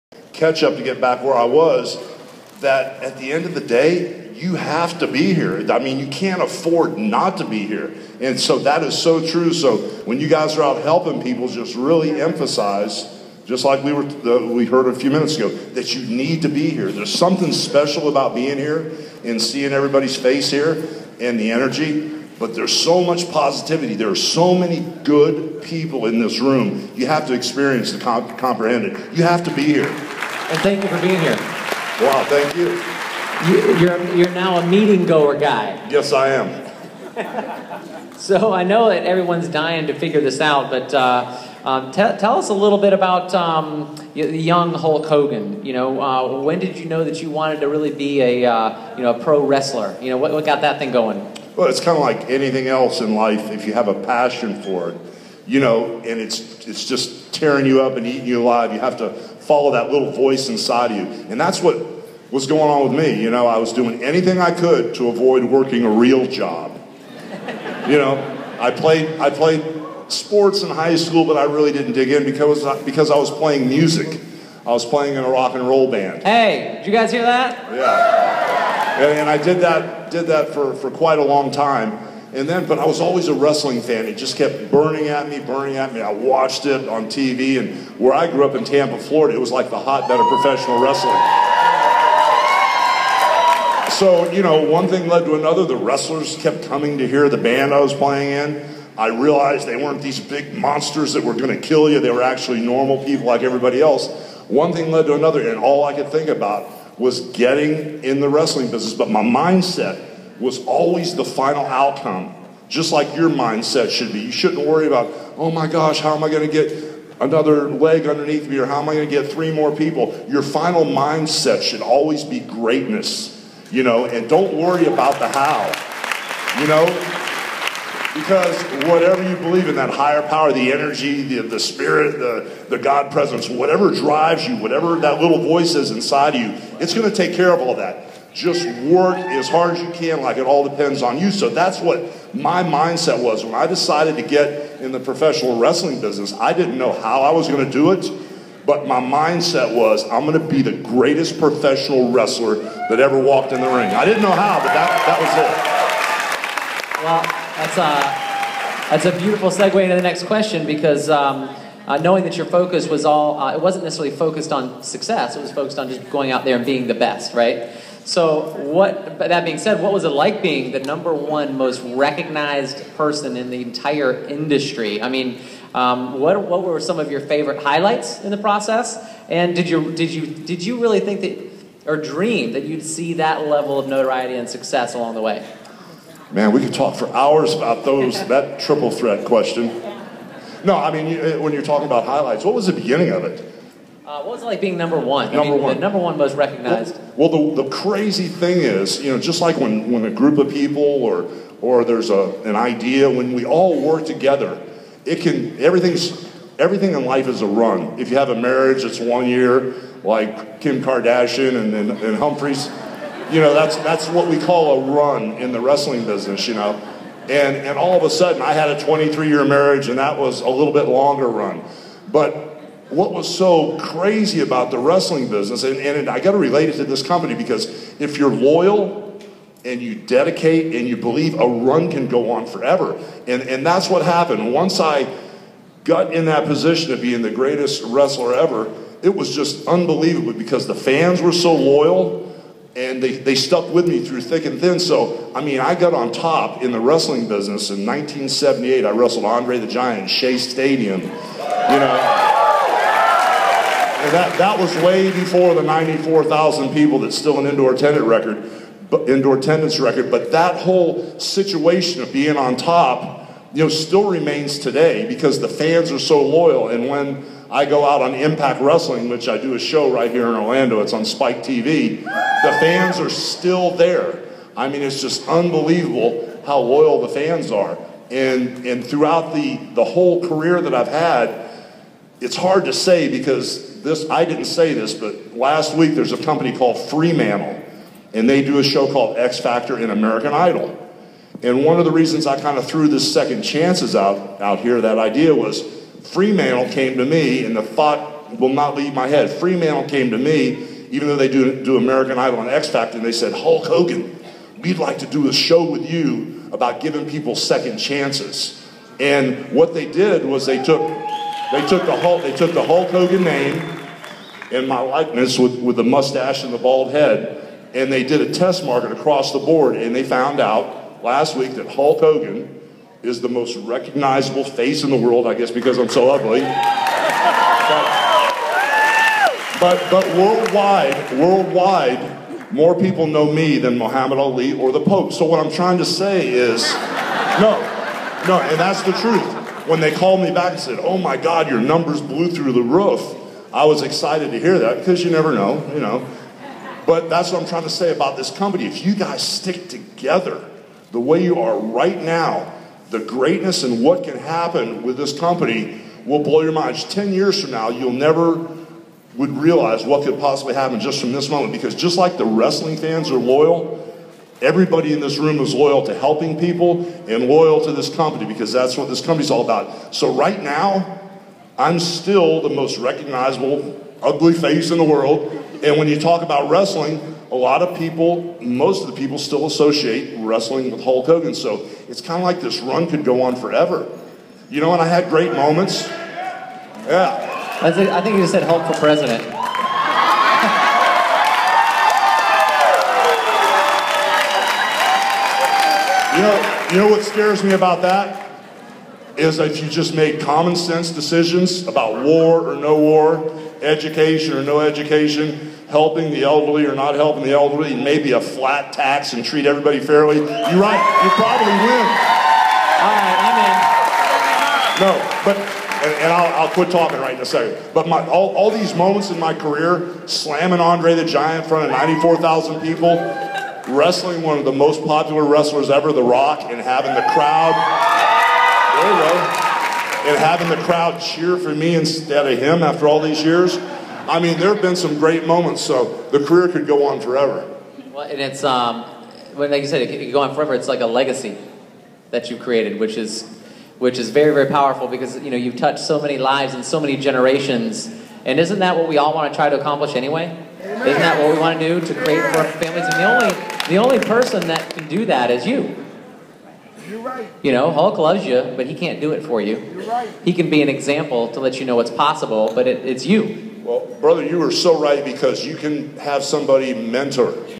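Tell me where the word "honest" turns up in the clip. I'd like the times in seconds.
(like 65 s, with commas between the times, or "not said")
not said.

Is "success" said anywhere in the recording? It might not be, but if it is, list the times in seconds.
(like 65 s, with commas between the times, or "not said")
164 s, 184 s.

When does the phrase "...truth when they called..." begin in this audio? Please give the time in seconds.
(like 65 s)
338 s.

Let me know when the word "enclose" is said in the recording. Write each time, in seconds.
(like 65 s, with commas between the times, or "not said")
not said.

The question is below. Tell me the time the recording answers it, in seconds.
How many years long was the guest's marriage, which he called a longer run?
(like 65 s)
218 s.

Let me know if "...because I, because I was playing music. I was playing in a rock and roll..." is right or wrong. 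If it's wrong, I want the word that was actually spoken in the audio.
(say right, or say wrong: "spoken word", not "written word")
right.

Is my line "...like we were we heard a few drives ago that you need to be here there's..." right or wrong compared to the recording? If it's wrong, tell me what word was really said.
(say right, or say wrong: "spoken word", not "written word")
wrong: "minutes", not "drives".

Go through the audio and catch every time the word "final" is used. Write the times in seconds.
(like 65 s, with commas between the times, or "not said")
111 s, 120 s.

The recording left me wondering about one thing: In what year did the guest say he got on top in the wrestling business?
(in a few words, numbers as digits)
1978.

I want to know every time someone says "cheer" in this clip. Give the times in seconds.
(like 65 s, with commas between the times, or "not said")
430 s.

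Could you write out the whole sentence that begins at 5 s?
I mean, you can't afford not to be here.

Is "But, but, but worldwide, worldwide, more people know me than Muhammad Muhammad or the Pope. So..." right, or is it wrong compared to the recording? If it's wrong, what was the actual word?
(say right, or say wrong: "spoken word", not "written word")
wrong: "Ali", not "Muhammad".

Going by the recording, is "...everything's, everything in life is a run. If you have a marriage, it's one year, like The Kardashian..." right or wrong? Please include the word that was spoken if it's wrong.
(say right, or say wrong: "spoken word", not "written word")
wrong: "Kim", not "The".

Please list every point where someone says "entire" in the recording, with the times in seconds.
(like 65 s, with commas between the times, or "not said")
173 s.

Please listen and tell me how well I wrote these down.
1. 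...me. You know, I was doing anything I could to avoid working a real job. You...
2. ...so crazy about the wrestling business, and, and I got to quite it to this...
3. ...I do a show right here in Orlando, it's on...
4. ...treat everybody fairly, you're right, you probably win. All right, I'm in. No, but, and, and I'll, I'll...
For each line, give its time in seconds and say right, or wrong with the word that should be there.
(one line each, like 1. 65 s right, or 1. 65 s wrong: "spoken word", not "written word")
1. 63 s right
2. 223 s wrong: "relate", not "quite"
3. 269 s right
4. 409 s right.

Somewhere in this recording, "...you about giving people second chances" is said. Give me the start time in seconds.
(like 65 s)
305 s.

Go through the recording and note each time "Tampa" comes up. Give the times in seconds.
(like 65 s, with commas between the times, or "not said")
88 s.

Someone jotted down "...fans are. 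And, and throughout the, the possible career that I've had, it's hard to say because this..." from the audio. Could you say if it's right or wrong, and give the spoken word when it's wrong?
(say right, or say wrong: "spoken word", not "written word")
wrong: "whole", not "possible".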